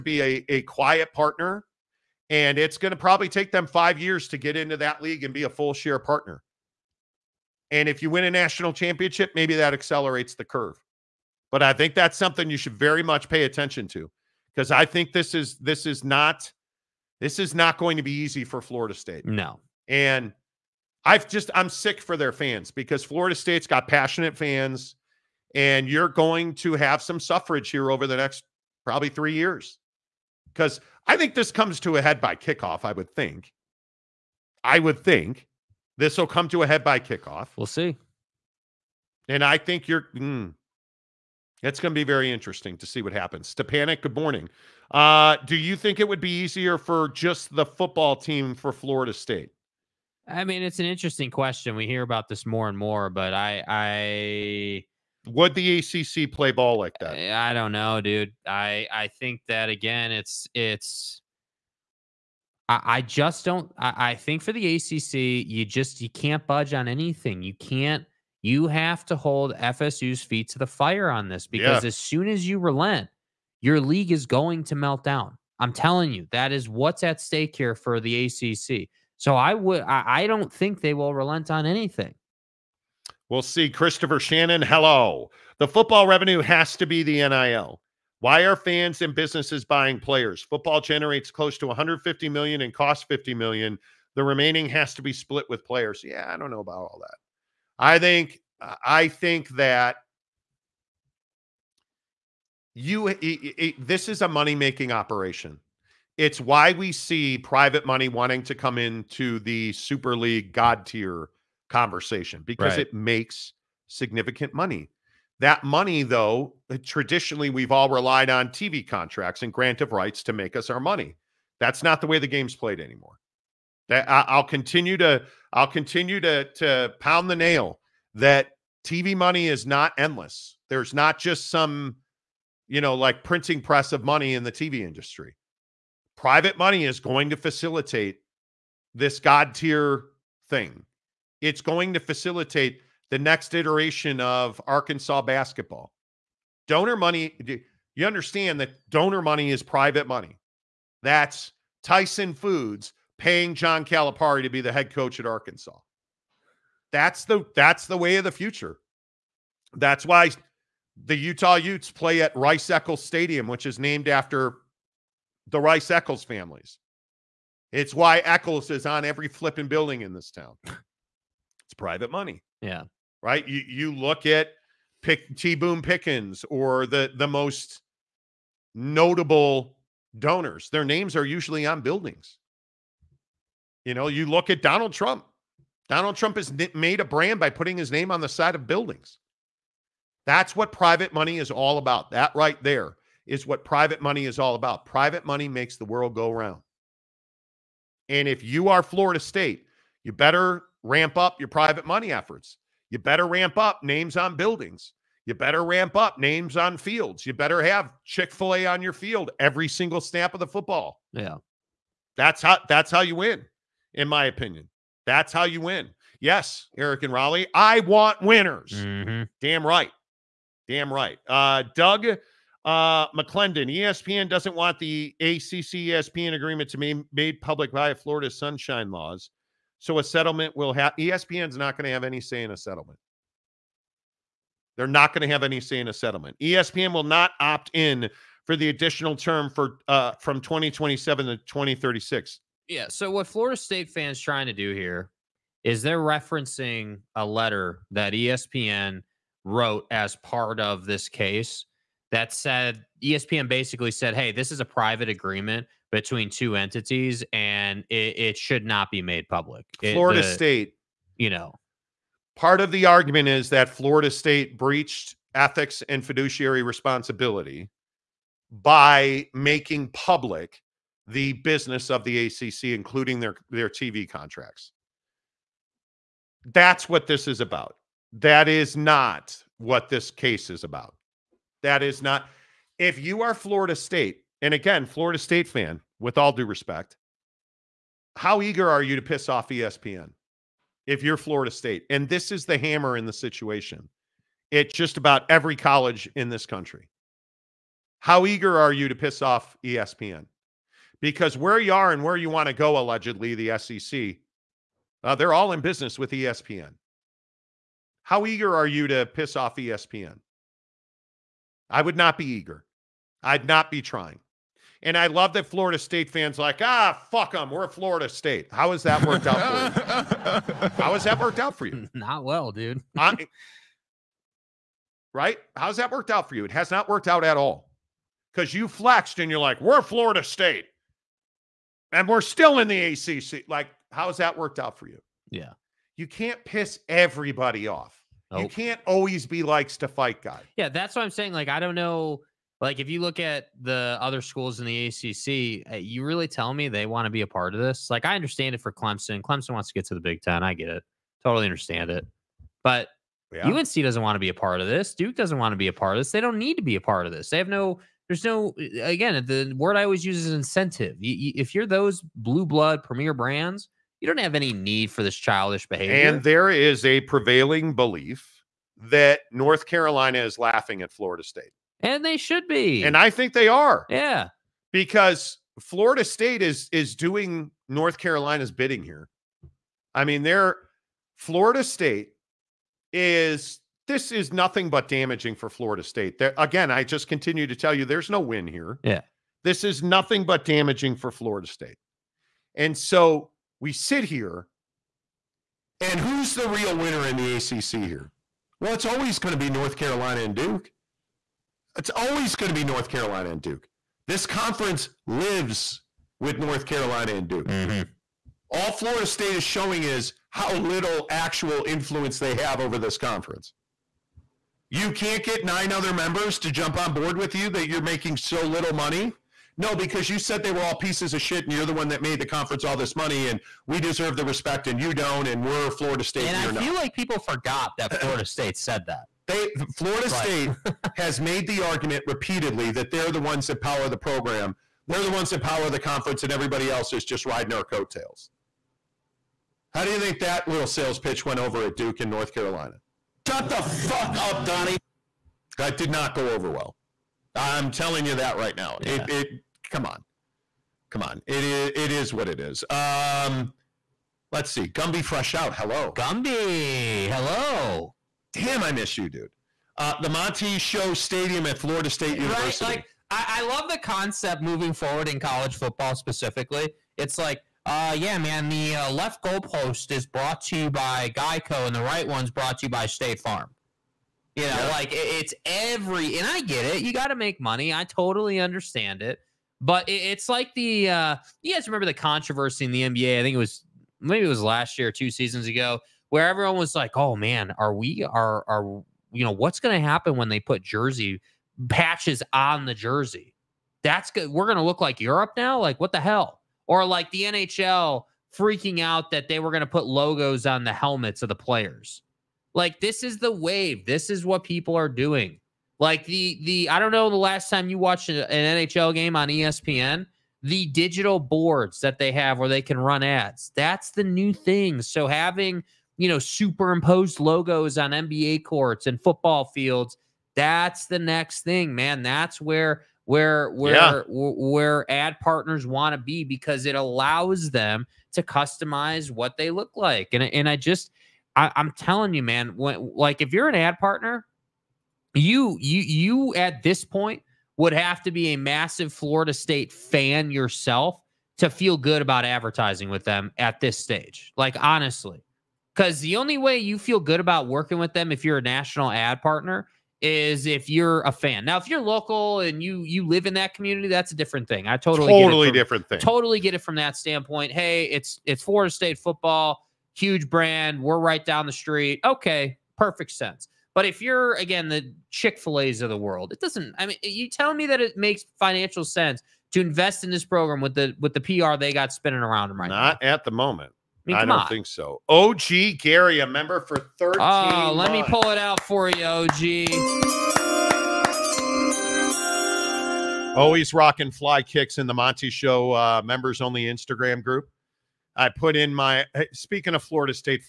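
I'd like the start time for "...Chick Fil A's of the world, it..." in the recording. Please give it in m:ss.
9:25.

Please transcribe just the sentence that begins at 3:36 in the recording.
Yes, Eric and Raleigh, I want winners.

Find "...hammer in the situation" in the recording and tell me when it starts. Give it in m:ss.
4:52.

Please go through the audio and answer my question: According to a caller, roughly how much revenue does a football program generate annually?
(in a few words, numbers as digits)
150 million.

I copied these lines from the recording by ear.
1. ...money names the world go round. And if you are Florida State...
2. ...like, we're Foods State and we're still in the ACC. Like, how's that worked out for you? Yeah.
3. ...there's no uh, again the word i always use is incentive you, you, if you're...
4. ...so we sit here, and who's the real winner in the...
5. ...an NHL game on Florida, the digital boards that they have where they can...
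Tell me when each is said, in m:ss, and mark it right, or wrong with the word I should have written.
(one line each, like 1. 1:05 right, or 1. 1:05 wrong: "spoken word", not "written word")
1. 3:15 wrong: "makes", not "names"
2. 5:29 wrong: "Florida", not "Foods"
3. 5:58 right
4. 6:32 right
5. 8:28 wrong: "ESPN", not "Florida".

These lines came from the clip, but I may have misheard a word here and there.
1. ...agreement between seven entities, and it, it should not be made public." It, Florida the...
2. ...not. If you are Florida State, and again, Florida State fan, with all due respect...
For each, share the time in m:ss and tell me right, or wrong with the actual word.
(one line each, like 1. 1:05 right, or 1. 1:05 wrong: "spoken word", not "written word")
1. 4:15 wrong: "two", not "seven"
2. 4:42 right.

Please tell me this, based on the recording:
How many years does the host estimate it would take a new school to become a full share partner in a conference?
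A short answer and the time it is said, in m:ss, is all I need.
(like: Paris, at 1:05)
5 years, at 0:03.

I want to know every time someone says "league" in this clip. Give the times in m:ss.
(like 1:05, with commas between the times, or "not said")
0:05, 1:13, 1:50.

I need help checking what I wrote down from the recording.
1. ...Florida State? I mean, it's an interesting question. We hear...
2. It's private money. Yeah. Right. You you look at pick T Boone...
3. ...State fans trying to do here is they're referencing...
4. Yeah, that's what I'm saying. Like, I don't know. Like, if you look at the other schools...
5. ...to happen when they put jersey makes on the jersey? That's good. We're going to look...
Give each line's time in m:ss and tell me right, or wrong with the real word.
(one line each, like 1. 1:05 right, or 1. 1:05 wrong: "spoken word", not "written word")
1. 0:48 right
2. 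2:50 right
3. 4:03 right
4. 5:40 right
5. 8:09 wrong: "patches", not "makes".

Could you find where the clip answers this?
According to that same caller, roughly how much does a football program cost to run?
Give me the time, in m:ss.
1:33.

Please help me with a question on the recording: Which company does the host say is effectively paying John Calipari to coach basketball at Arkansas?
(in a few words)
Tyson Foods.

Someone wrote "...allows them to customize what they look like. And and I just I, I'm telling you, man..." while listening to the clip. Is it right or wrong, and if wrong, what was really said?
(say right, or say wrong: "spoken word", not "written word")
right.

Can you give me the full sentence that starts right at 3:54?
They're not going to have any say in a settlement.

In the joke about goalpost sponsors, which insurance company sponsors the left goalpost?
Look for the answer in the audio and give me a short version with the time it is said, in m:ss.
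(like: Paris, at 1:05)
Geico, at 7:51.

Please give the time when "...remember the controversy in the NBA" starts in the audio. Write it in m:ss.
8:01.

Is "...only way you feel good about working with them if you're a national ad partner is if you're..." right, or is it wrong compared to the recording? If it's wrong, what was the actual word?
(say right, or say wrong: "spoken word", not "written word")
right.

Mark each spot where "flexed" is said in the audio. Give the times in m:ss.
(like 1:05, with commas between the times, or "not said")
5:28.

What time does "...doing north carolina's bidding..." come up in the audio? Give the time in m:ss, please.
6:16.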